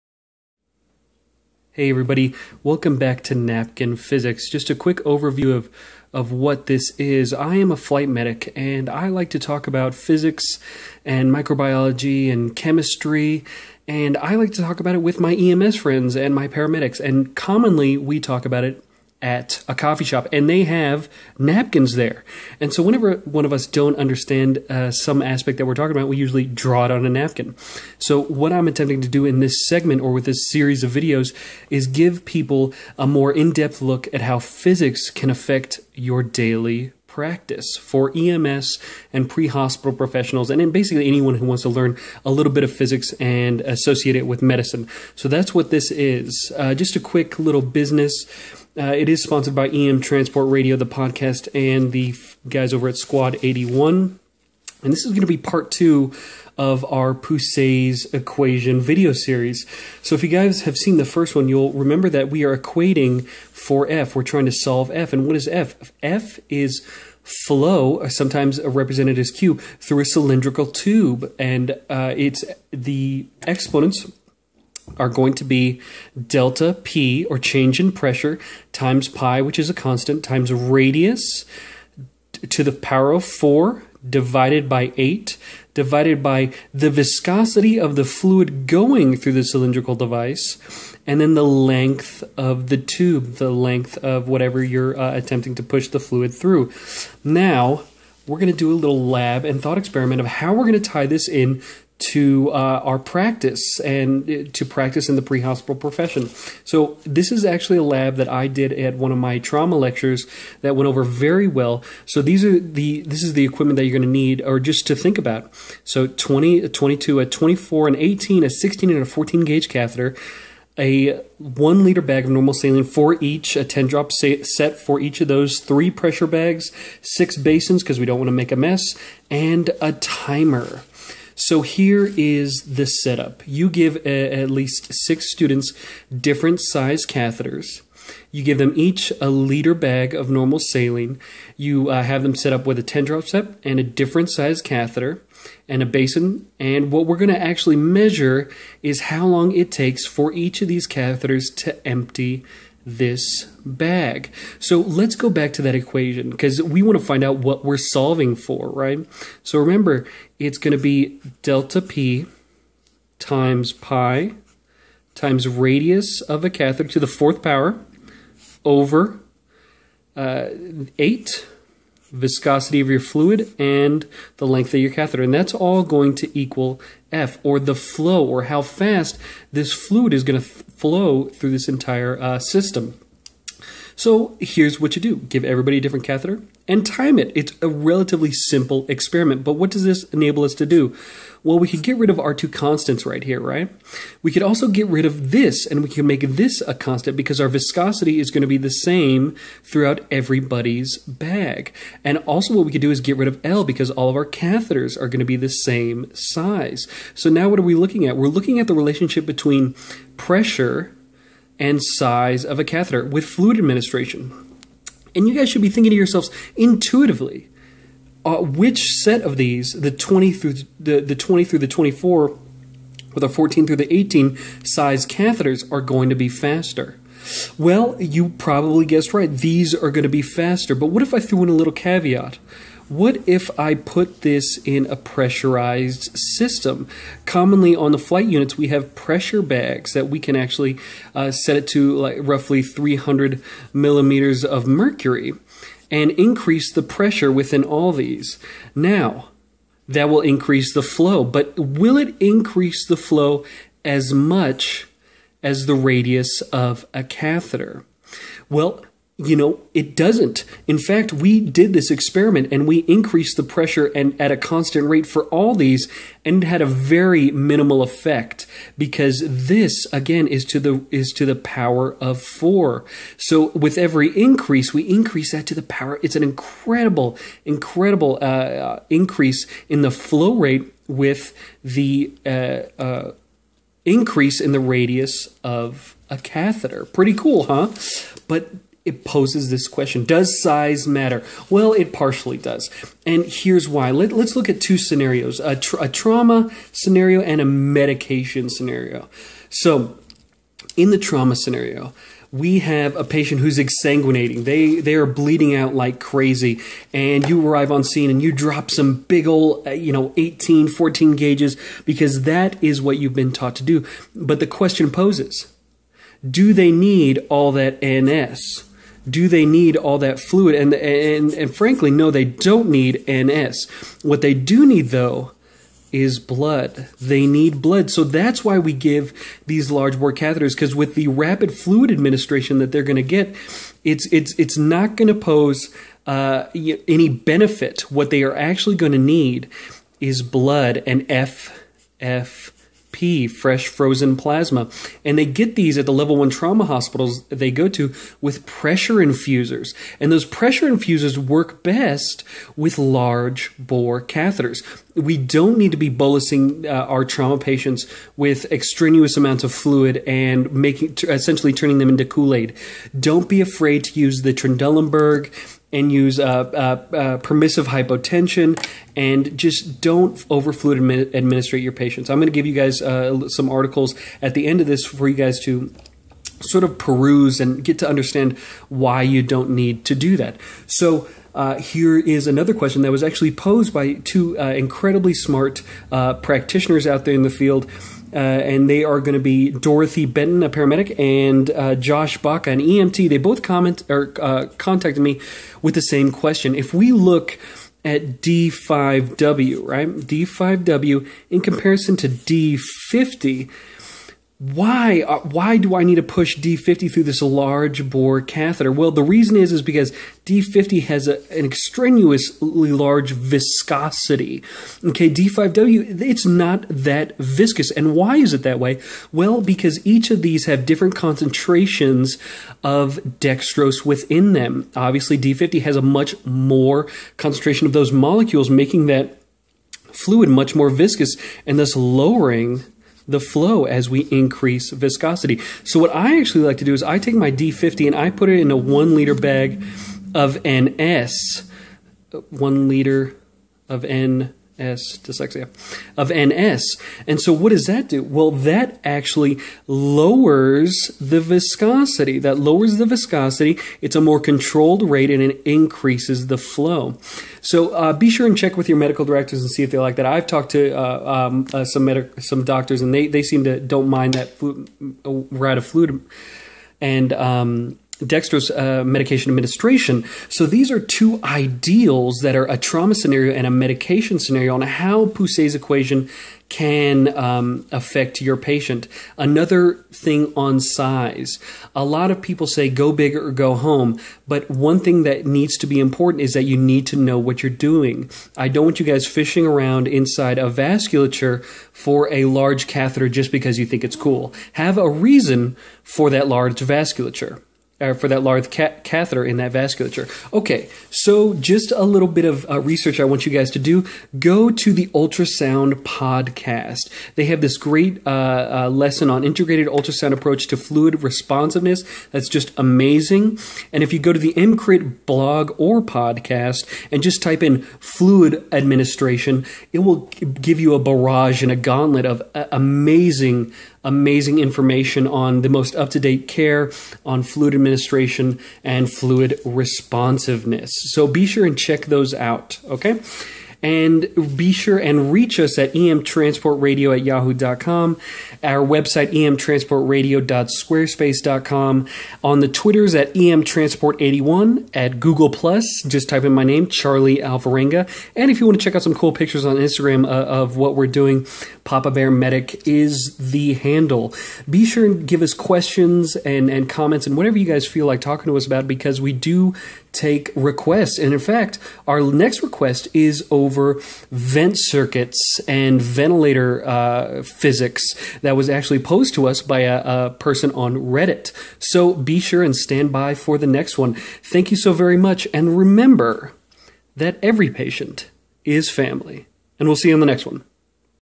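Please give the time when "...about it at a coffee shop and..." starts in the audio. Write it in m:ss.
0:18.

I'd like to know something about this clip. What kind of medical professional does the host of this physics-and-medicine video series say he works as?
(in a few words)
flight medic.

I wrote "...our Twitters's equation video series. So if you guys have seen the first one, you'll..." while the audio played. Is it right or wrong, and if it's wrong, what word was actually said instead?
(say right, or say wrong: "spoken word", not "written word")
wrong: "Poiseuille", not "Twitters".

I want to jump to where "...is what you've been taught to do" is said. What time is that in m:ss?
5:12.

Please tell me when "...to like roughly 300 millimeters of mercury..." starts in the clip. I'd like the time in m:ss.
4:01.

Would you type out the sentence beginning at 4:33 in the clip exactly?
So with every increase, we increase that to the power.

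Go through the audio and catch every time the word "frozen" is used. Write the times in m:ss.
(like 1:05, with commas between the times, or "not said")
5:43.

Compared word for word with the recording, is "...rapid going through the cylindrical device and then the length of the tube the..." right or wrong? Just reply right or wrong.
wrong.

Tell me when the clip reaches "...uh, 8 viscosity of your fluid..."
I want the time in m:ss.
2:50.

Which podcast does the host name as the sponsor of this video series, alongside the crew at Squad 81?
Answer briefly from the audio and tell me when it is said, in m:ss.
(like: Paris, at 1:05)
EM Transport Radio, at 0:49.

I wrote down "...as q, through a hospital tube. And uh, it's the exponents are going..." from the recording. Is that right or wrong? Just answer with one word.
wrong.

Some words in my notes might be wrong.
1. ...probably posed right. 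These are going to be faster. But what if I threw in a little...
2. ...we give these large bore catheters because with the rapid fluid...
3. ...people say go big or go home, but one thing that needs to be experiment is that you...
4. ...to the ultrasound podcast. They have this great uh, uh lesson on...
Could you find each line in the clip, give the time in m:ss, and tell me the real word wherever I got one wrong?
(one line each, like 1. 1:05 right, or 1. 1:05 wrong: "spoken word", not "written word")
1. 3:48 wrong: "guessed", not "posed"
2. 5:28 right
3. 8:02 wrong: "important", not "experiment"
4. 8:24 right.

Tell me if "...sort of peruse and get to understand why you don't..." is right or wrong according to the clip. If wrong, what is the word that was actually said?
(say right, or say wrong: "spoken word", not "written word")
right.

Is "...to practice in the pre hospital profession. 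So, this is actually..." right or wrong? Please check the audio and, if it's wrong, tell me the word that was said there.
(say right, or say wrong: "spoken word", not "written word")
right.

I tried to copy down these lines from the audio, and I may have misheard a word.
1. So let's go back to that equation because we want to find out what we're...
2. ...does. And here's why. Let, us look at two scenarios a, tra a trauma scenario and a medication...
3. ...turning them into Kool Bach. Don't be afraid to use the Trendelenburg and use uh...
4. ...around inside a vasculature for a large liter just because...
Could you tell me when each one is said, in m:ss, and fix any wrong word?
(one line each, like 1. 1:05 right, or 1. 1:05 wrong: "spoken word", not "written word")
1. 2:34 right
2. 4:52 right
3. 6:01 wrong: "Aid", not "Bach"
4. 8:09 wrong: "catheter", not "liter".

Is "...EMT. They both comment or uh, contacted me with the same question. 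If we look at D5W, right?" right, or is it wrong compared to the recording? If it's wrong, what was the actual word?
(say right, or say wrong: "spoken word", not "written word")
right.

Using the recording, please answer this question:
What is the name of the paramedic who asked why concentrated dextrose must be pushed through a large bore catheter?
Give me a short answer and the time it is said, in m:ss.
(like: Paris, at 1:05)
Dorothy Benton, at 6:29.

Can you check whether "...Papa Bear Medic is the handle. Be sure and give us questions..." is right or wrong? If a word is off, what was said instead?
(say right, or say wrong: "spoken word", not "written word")
right.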